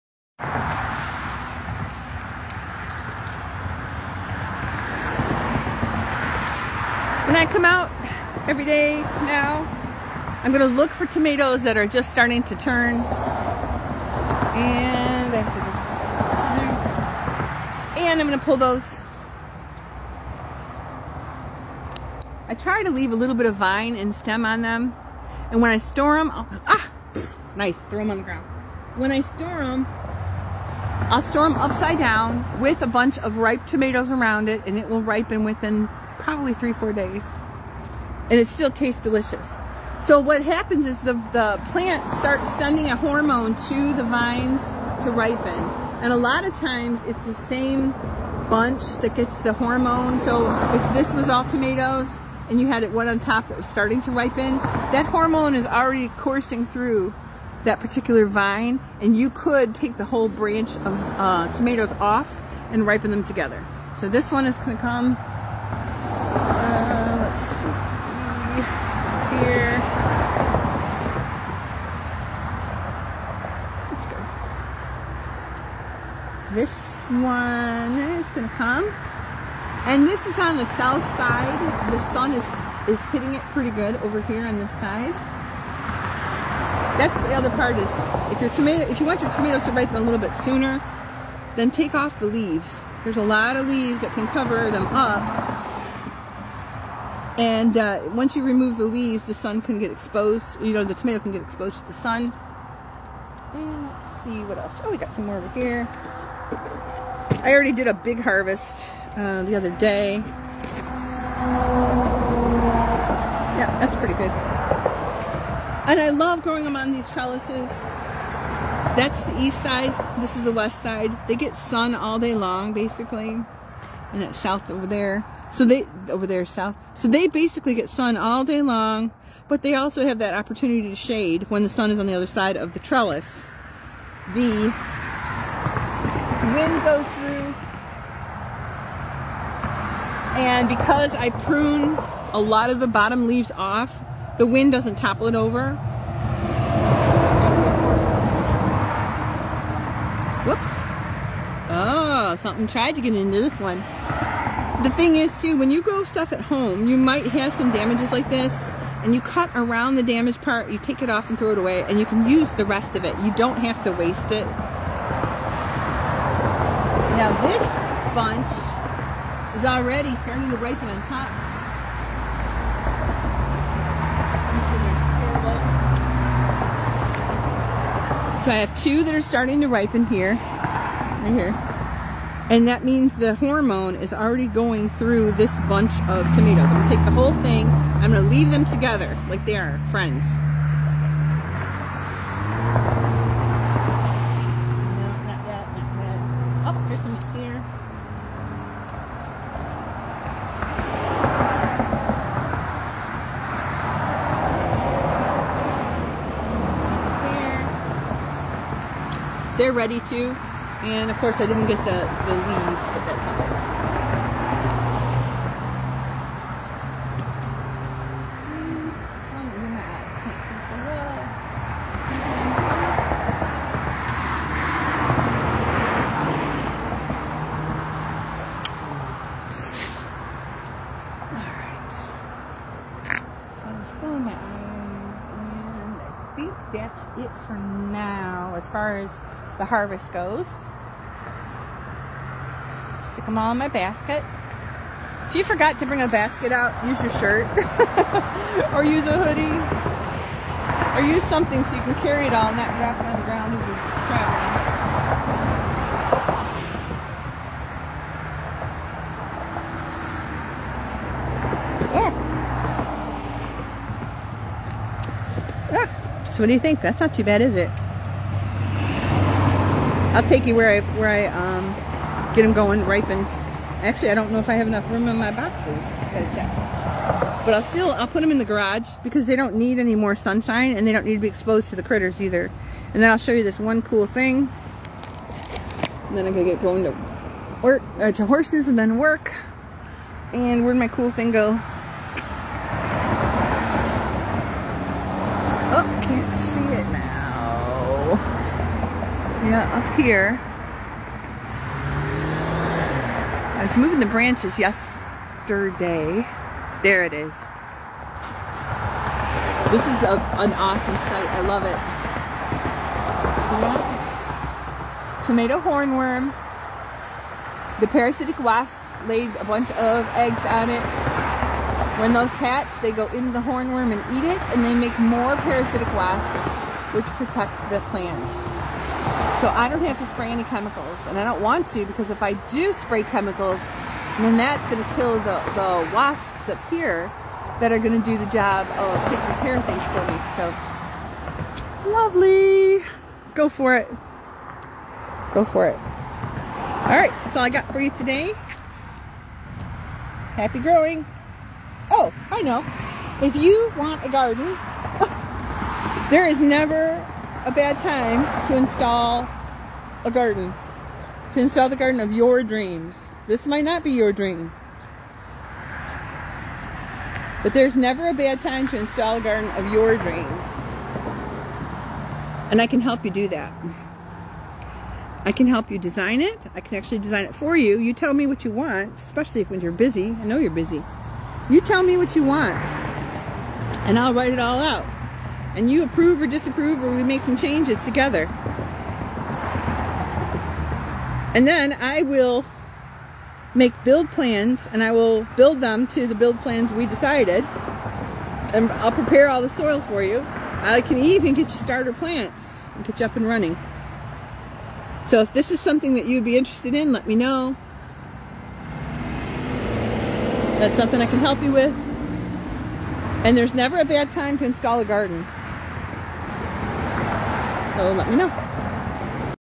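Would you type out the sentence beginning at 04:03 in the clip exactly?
Stick them all in my basket.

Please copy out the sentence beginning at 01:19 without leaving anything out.
And this is on the south side.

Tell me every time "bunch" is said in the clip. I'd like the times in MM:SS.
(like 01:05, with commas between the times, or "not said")
00:32, 00:48, 02:48, 03:05, 05:19.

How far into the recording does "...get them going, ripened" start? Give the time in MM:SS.
04:32.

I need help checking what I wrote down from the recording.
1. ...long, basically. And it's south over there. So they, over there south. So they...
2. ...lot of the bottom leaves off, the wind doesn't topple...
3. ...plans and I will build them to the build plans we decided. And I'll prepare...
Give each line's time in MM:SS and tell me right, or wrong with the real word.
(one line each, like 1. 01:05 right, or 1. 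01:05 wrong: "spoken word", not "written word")
1. 02:02 right
2. 02:22 right
3. 06:34 right.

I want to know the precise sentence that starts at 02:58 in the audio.
So I have two that are starting to ripen here, right here.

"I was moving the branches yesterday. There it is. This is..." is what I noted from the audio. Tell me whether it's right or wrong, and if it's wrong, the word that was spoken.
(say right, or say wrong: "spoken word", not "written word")
right.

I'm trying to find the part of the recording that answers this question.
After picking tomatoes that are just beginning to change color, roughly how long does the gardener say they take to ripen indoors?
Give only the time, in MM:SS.
00:36.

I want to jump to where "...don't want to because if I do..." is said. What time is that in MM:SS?
05:31.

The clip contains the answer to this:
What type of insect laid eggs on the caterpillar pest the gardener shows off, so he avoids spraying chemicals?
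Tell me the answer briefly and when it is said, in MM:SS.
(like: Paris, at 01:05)
Parasitic wasp, at 05:17.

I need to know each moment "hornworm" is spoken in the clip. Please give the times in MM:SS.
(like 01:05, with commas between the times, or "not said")
05:15, 05:23.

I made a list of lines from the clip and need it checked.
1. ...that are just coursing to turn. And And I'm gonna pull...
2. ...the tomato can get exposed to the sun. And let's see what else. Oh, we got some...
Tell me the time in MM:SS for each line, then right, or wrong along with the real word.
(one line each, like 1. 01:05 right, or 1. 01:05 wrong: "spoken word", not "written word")
1. 00:11 wrong: "starting", not "coursing"
2. 01:40 right.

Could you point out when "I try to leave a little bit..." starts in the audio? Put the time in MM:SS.
00:22.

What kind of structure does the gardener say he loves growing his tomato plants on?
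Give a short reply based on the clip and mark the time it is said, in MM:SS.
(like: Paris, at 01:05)
Trellises, at 01:57.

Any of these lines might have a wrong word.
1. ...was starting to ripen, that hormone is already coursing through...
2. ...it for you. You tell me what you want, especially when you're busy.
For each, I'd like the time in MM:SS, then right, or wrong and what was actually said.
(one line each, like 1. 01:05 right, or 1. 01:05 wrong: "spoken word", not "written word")
1. 00:53 right
2. 06:17 right.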